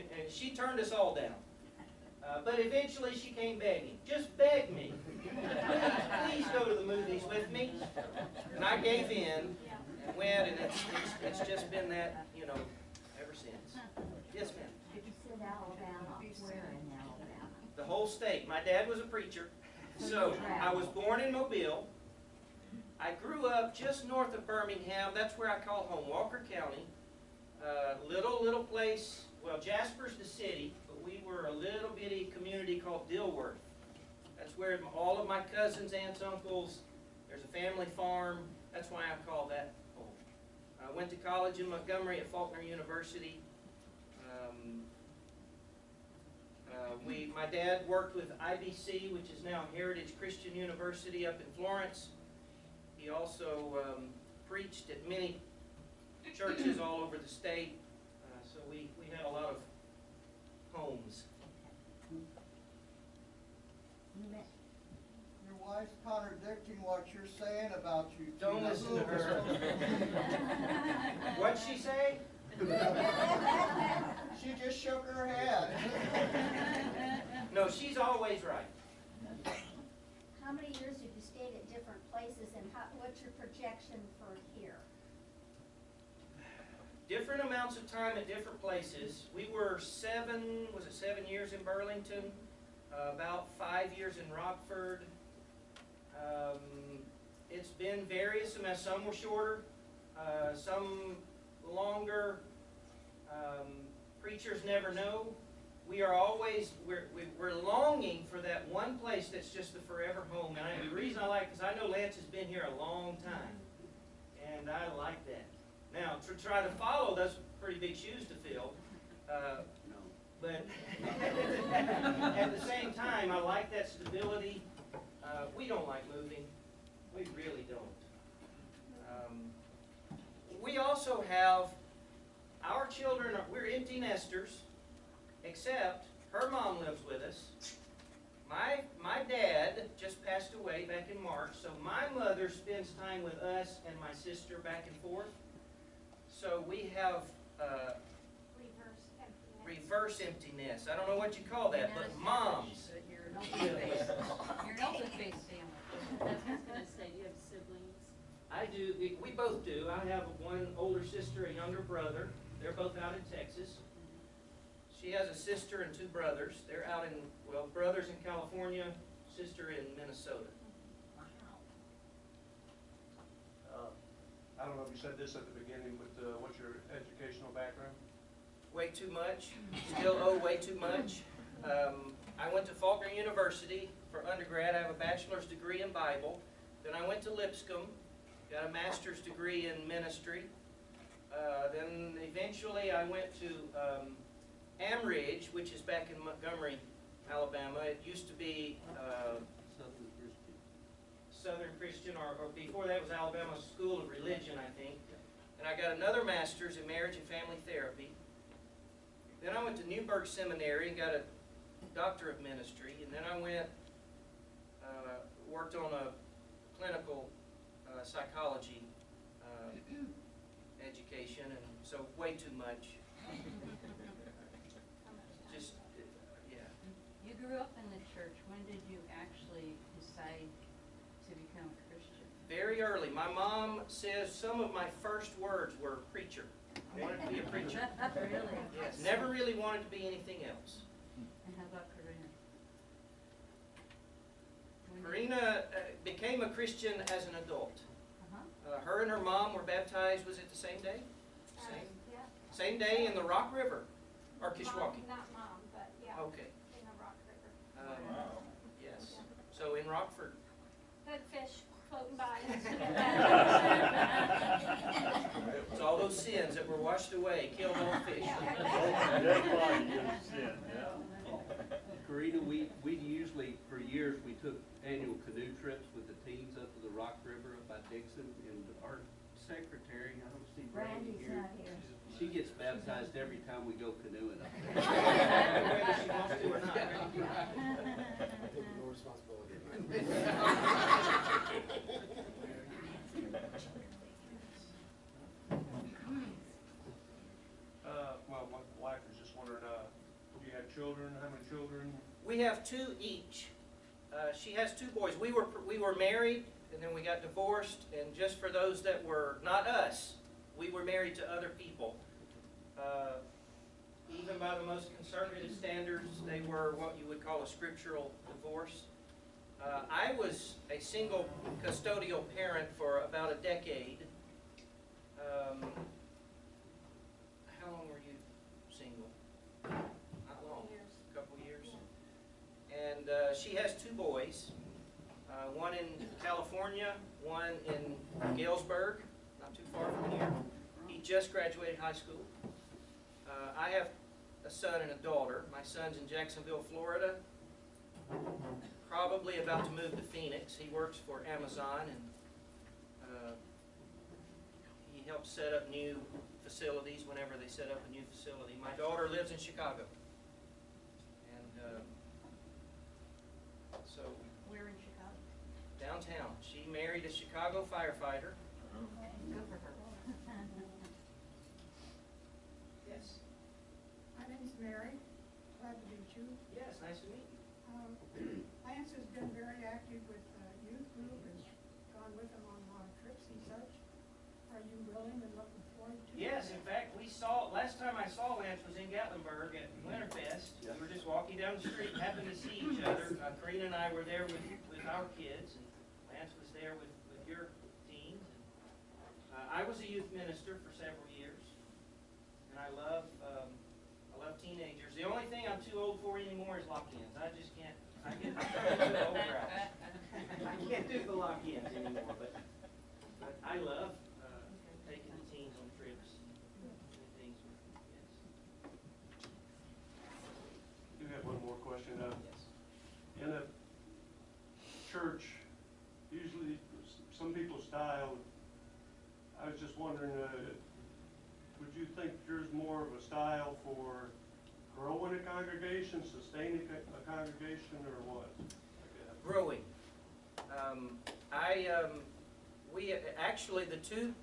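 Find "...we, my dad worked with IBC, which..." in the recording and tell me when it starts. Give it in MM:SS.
00:47.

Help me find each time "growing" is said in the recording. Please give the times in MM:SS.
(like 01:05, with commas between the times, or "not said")
07:14, 07:19.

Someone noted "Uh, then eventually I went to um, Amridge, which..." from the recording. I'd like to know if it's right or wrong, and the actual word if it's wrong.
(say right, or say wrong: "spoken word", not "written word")
right.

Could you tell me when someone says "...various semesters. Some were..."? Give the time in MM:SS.
01:38.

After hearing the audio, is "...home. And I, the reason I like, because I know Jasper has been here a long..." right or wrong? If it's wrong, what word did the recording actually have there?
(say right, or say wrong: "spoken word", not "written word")
wrong: "Lance", not "Jasper".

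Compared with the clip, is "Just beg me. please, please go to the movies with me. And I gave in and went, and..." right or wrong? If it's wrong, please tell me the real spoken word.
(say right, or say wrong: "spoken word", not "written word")
right.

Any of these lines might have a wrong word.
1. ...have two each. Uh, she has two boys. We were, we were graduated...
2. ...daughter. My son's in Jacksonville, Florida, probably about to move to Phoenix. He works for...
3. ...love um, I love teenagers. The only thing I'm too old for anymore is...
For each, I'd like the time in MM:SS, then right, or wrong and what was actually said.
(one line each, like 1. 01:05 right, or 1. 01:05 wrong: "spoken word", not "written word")
1. 05:02 wrong: "married", not "graduated"
2. 05:45 right
3. 06:42 right.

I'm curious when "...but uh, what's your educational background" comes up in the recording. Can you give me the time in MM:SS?
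02:55.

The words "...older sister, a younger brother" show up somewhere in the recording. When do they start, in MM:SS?
02:40.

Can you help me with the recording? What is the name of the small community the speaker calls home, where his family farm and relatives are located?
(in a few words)
Dilworth.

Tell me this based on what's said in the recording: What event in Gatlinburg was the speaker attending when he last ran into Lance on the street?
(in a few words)
Winterfest.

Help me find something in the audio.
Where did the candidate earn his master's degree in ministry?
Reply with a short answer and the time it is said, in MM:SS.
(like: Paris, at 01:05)
Lipscomb, at 03:07.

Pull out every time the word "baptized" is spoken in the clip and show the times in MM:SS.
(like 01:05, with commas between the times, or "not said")
04:09, 04:42.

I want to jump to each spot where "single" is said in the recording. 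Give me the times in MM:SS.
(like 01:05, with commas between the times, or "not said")
05:20.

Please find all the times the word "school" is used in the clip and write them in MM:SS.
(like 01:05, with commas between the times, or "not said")
03:23, 05:41.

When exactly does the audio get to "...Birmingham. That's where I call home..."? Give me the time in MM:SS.
00:24.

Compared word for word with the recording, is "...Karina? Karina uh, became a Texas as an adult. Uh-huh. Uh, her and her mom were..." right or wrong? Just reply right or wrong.
wrong.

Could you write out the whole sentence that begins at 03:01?
Um, I went to Faulkner University for undergrad.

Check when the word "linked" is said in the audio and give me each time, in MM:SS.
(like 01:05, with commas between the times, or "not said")
not said.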